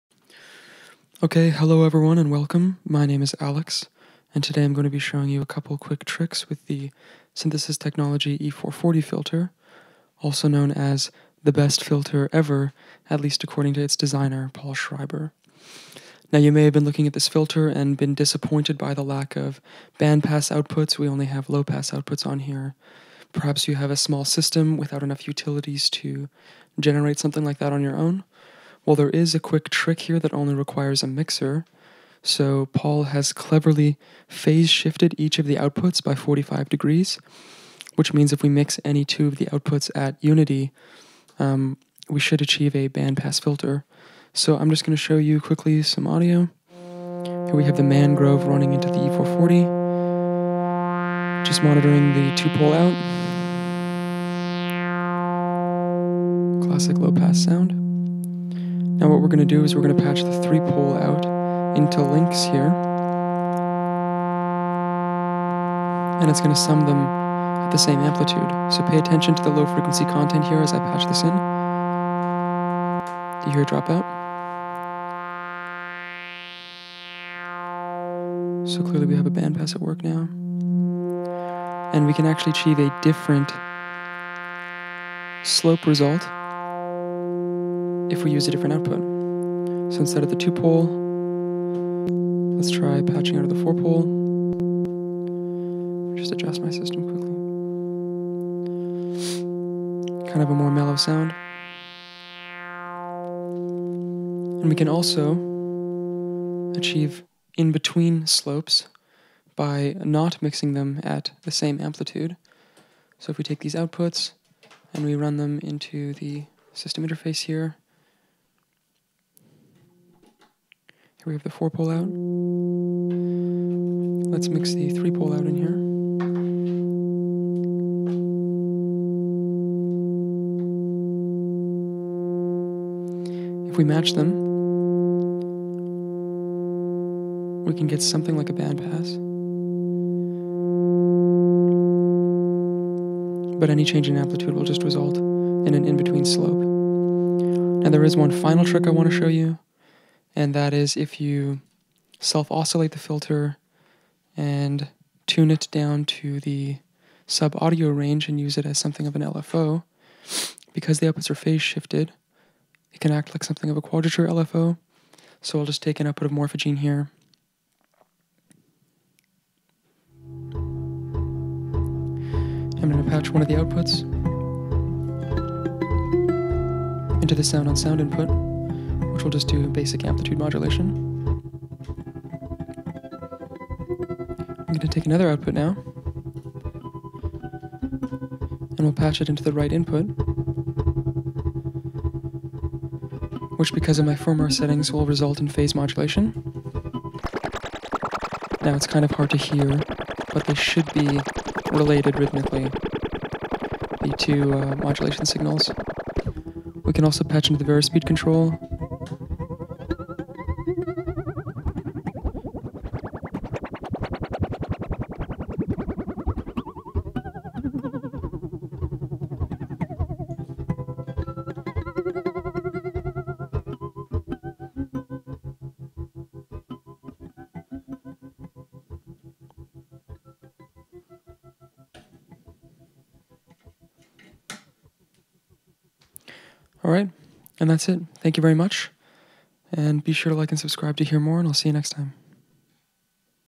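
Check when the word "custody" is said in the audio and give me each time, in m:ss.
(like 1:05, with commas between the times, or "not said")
not said.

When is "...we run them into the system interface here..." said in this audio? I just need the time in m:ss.
1:55.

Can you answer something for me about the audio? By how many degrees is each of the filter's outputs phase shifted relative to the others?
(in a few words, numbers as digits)
45.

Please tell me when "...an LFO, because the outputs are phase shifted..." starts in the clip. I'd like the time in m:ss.
2:39.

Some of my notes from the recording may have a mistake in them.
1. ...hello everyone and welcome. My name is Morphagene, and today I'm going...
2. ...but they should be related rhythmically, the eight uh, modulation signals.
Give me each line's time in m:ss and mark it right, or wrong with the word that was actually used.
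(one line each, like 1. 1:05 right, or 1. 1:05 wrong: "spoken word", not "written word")
1. 0:01 wrong: "Alex", not "Morphagene"
2. 3:20 wrong: "two", not "eight".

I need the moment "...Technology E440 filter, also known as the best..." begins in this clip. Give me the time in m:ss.
0:07.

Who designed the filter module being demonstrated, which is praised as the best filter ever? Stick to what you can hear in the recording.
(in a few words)
Paul Schreiber.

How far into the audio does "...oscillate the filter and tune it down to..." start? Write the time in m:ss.
2:32.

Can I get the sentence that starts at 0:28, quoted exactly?
Well, there is a quick trick here that only requires a mixer.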